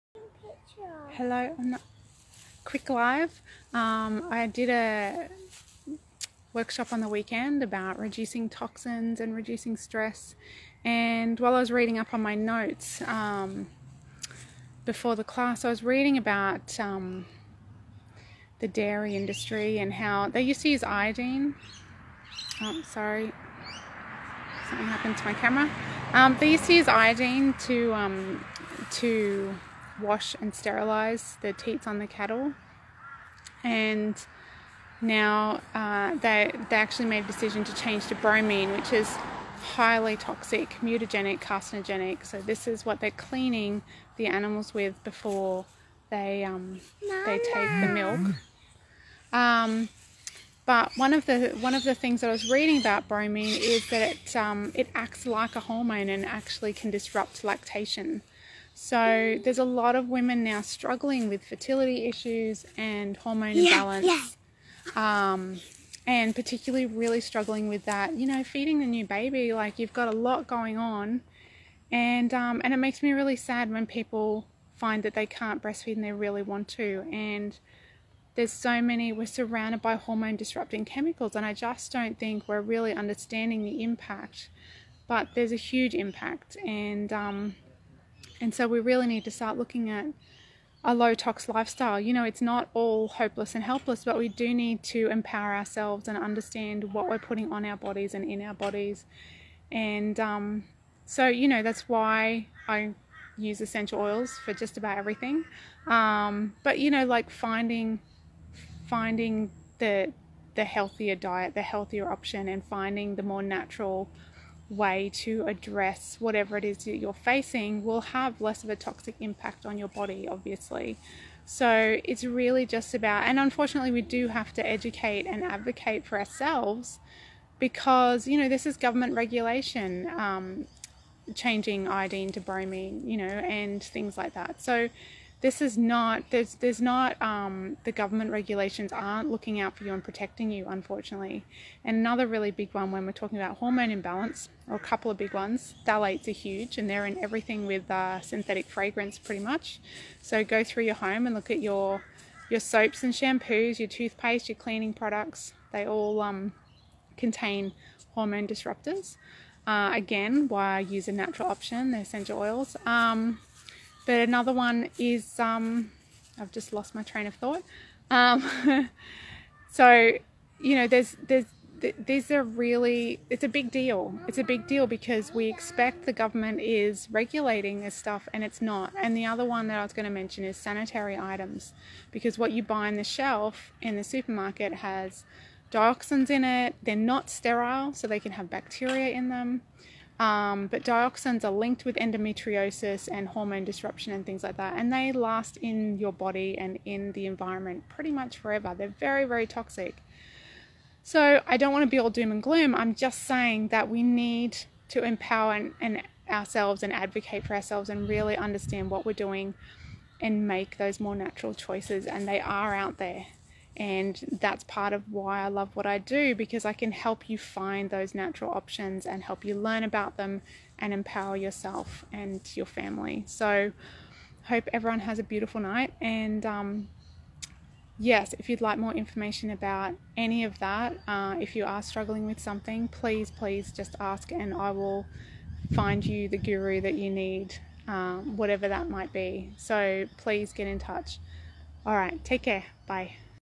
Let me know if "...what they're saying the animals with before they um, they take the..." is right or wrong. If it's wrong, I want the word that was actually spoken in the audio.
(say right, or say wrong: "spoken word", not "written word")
wrong: "cleaning", not "saying".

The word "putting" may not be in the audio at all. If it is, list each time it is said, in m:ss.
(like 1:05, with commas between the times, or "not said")
1:37.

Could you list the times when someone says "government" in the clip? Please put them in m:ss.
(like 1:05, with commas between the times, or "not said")
2:08, 2:17, 2:56.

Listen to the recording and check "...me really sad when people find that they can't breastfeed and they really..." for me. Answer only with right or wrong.
right.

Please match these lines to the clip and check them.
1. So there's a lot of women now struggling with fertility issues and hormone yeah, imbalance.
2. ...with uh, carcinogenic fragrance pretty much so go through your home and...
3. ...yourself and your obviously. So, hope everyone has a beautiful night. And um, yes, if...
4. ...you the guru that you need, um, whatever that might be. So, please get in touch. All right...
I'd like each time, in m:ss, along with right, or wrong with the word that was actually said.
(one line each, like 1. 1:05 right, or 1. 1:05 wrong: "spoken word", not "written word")
1. 0:58 right
2. 2:27 wrong: "synthetic", not "carcinogenic"
3. 3:41 wrong: "family", not "obviously"
4. 3:56 right.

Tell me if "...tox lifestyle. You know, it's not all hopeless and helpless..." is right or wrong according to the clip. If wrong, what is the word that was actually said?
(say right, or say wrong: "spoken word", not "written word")
right.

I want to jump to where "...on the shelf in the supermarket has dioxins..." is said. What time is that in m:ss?
3:02.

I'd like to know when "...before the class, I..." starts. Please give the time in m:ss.
0:14.